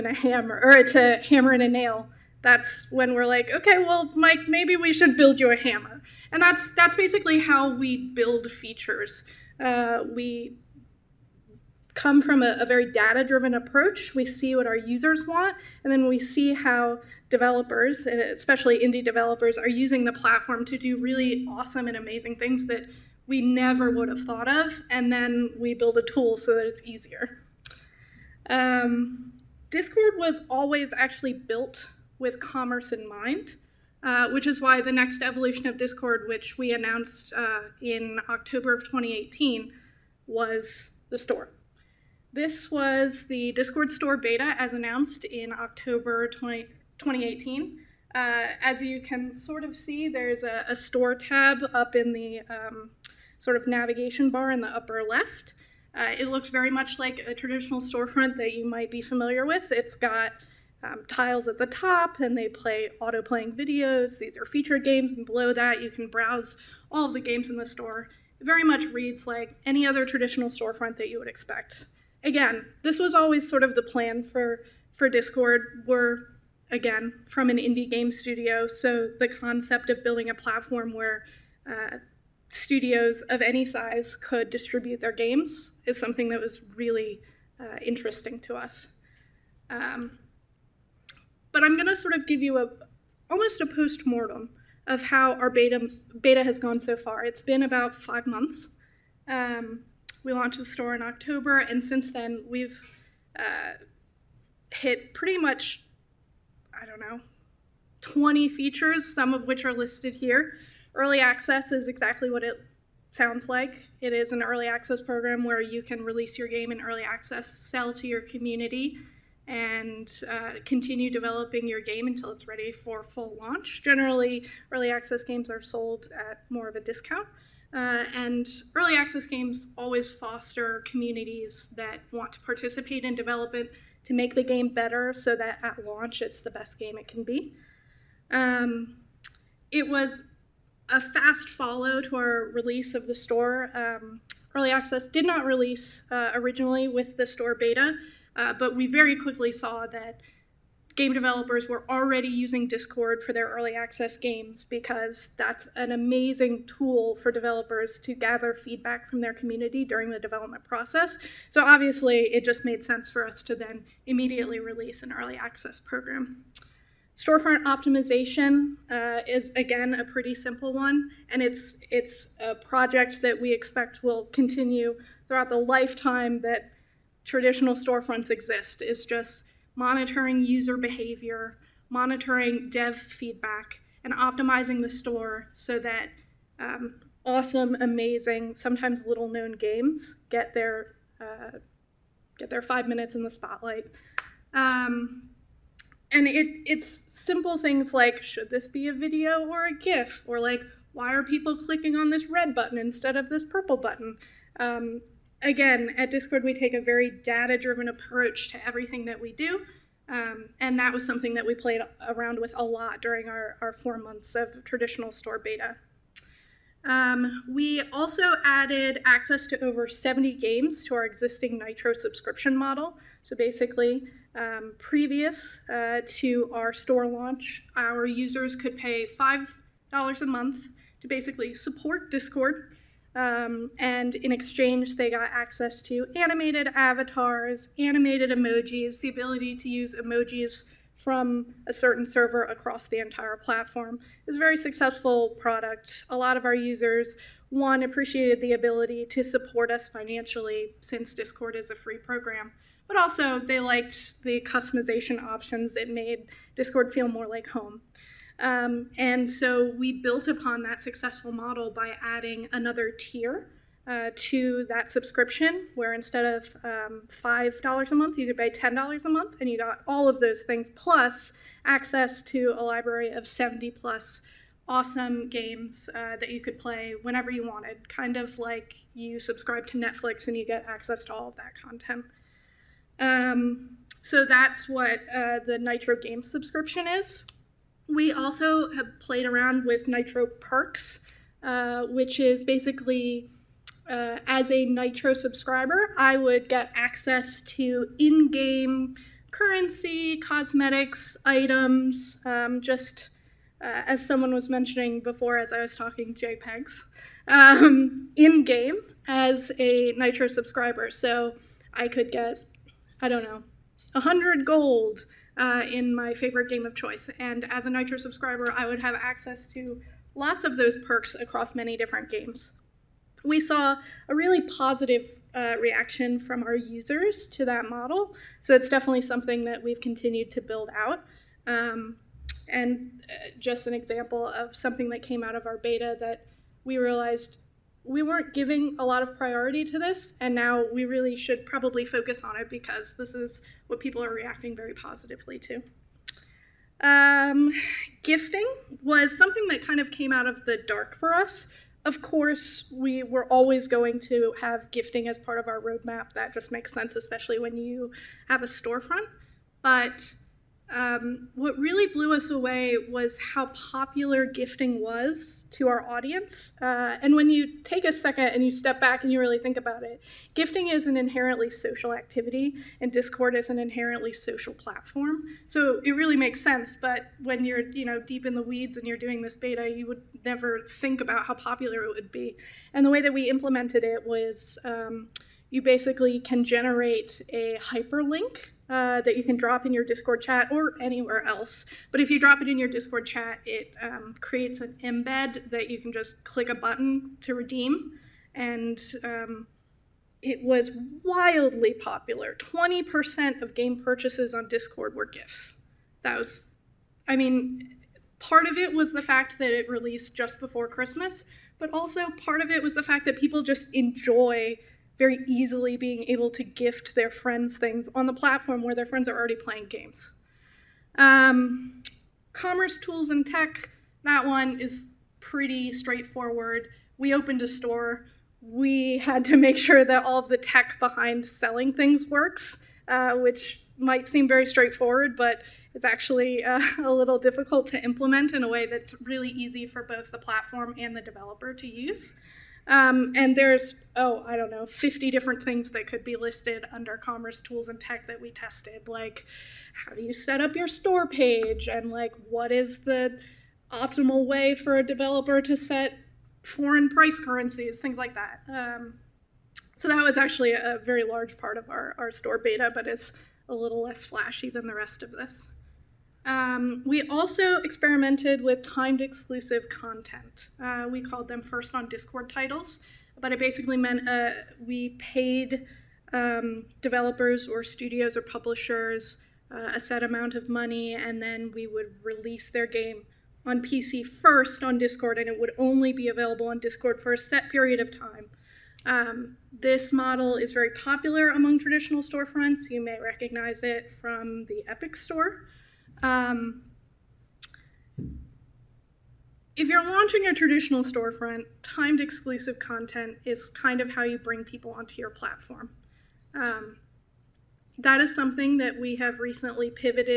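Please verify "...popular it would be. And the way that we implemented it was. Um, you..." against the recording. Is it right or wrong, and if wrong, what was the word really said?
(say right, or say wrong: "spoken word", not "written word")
right.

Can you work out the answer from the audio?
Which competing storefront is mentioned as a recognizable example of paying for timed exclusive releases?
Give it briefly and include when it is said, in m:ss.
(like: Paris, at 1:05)
Epic Store, at 8:14.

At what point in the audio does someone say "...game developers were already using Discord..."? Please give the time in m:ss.
2:30.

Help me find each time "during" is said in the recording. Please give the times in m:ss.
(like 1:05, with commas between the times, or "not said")
2:39, 3:33.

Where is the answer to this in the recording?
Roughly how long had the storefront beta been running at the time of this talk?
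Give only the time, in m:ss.
1:37.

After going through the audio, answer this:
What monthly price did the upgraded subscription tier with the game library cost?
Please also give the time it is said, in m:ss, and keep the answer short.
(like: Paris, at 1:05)
$10, at 4:28.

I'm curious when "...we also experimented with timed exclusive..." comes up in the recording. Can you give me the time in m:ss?
7:46.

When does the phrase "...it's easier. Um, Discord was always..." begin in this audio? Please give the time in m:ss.
0:26.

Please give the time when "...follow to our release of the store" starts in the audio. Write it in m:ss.
2:21.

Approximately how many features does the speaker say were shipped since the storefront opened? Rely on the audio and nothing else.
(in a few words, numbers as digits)
20.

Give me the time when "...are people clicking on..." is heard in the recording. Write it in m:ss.
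3:21.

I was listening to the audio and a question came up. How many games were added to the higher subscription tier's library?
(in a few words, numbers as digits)
Over 70.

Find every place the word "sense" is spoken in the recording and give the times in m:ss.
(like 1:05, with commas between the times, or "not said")
2:42, 5:56, 6:16.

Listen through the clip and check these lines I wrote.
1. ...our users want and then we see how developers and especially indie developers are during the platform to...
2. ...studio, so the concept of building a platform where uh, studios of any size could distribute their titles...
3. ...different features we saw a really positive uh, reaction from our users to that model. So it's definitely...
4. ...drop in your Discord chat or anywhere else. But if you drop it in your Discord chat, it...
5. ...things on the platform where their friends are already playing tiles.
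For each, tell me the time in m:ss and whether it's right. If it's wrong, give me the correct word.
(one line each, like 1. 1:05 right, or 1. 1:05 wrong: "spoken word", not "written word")
1. 0:14 wrong: "using", not "during"
2. 1:18 wrong: "games", not "titles"
3. 5:21 wrong: "games", not "features"
4. 6:29 right
5. 6:57 wrong: "games", not "tiles".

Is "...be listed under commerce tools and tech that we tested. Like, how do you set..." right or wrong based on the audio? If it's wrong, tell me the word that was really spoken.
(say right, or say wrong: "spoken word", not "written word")
right.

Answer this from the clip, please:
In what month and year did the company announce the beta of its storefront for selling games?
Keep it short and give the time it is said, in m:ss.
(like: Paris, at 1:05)
October 2018, at 0:38.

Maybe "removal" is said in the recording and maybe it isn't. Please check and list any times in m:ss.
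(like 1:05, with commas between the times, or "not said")
not said.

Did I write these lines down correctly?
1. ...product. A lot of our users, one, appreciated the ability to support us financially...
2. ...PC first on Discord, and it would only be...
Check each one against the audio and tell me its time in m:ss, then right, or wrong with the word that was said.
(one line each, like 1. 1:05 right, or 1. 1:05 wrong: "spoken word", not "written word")
1. 4:05 right
2. 8:03 right.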